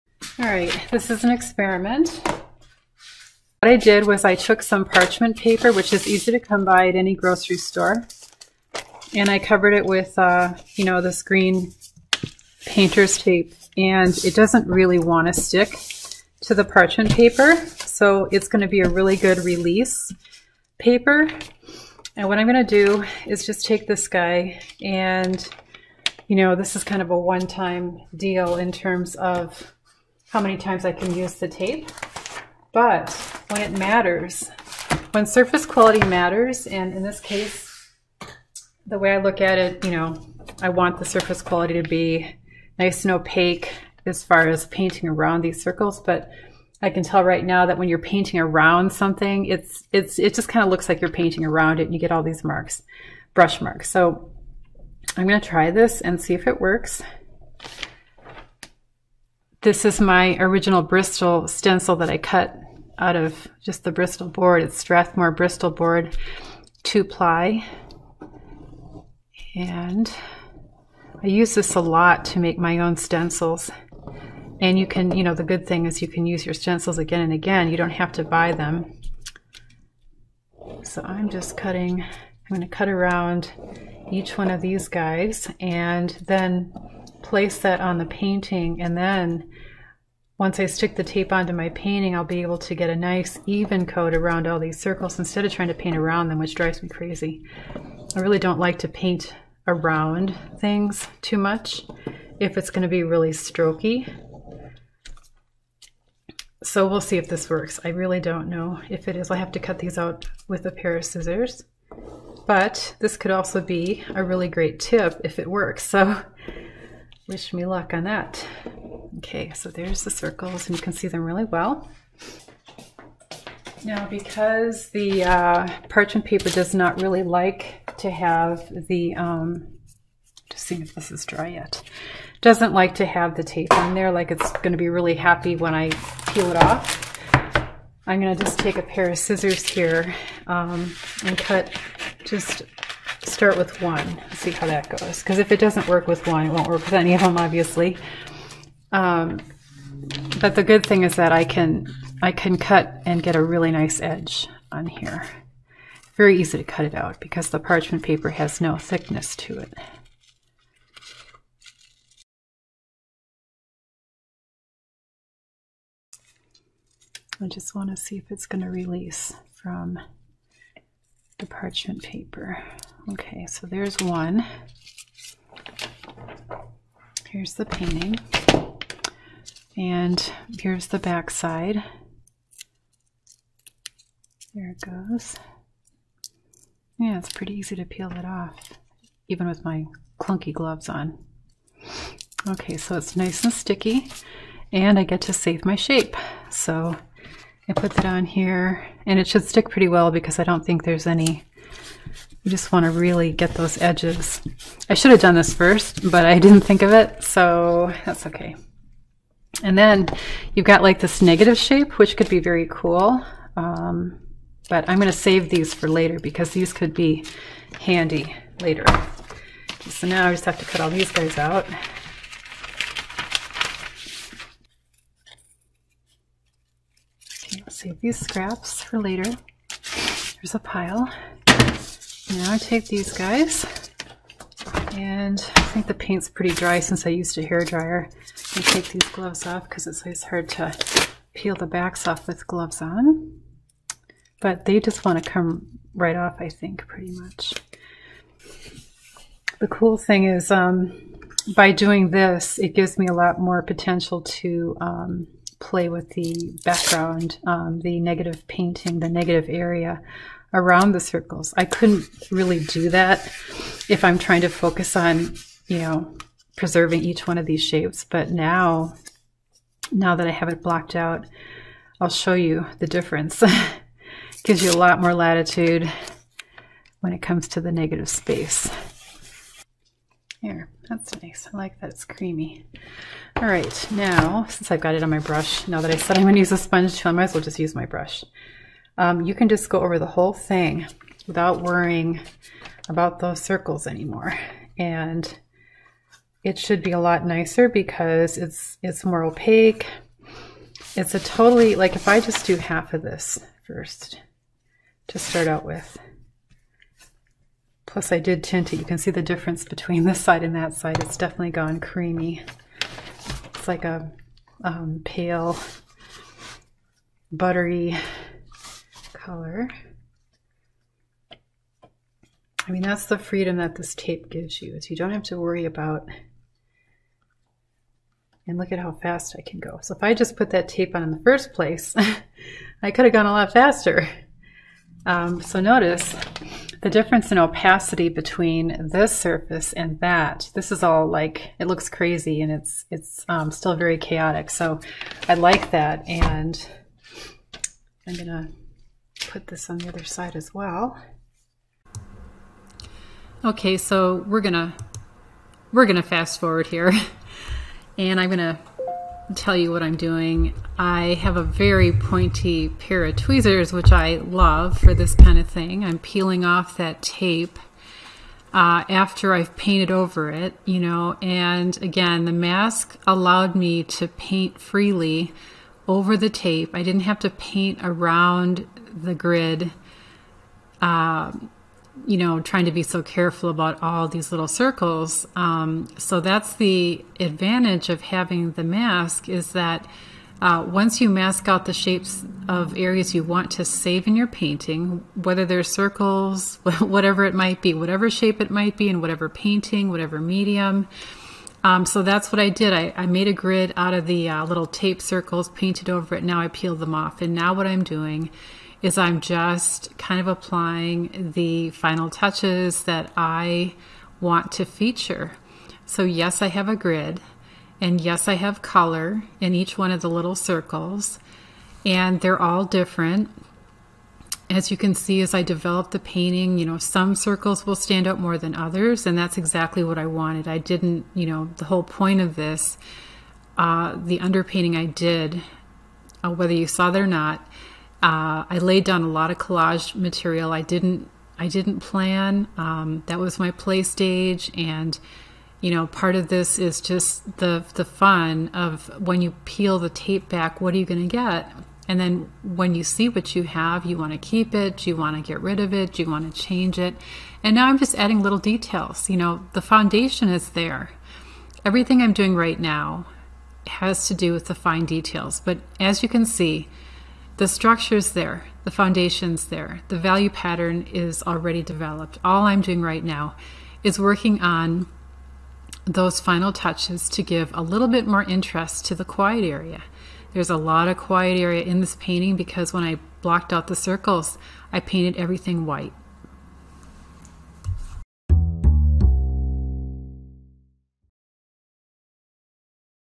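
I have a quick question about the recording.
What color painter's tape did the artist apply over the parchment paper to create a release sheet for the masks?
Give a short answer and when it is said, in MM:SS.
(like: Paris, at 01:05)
green, at 00:11.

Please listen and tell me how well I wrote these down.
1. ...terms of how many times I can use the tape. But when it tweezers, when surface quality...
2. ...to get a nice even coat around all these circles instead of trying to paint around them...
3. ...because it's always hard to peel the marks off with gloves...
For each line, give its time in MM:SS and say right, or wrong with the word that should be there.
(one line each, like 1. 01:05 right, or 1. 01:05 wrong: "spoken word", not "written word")
1. 00:28 wrong: "matters", not "tweezers"
2. 01:32 right
3. 03:59 wrong: "backs", not "marks".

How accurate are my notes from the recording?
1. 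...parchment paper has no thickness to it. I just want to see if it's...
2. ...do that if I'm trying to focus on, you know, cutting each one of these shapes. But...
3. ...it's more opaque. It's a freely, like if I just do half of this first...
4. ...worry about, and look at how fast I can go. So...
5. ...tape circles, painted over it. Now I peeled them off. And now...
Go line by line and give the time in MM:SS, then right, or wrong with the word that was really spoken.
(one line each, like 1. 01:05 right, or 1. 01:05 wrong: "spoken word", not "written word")
1. 02:37 right
2. 04:22 wrong: "preserving", not "cutting"
3. 04:58 wrong: "totally", not "freely"
4. 05:25 right
5. 06:44 right.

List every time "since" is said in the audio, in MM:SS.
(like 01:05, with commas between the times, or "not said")
03:56, 04:44.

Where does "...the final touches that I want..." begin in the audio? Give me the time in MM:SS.
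06:51.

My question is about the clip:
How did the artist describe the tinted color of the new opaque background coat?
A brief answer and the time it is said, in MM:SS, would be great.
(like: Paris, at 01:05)
pale, buttery, at 05:15.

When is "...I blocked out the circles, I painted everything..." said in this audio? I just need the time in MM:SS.
08:02.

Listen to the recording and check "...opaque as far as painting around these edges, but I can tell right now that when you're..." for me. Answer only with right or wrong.
wrong.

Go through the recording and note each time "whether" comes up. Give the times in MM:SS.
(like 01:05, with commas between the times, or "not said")
06:35, 07:16.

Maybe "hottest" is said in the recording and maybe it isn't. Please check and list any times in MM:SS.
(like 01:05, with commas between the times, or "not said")
not said.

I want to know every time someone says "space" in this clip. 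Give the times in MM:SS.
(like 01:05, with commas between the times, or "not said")
04:38.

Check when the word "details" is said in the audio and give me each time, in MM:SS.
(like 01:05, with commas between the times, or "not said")
07:38, 07:44.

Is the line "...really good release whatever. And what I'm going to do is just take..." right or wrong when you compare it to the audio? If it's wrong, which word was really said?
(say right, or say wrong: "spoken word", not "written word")
wrong: "paper", not "whatever".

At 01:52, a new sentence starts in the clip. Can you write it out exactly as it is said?
But this could also be a really great tip if it works.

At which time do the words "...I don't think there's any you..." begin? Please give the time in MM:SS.
03:20.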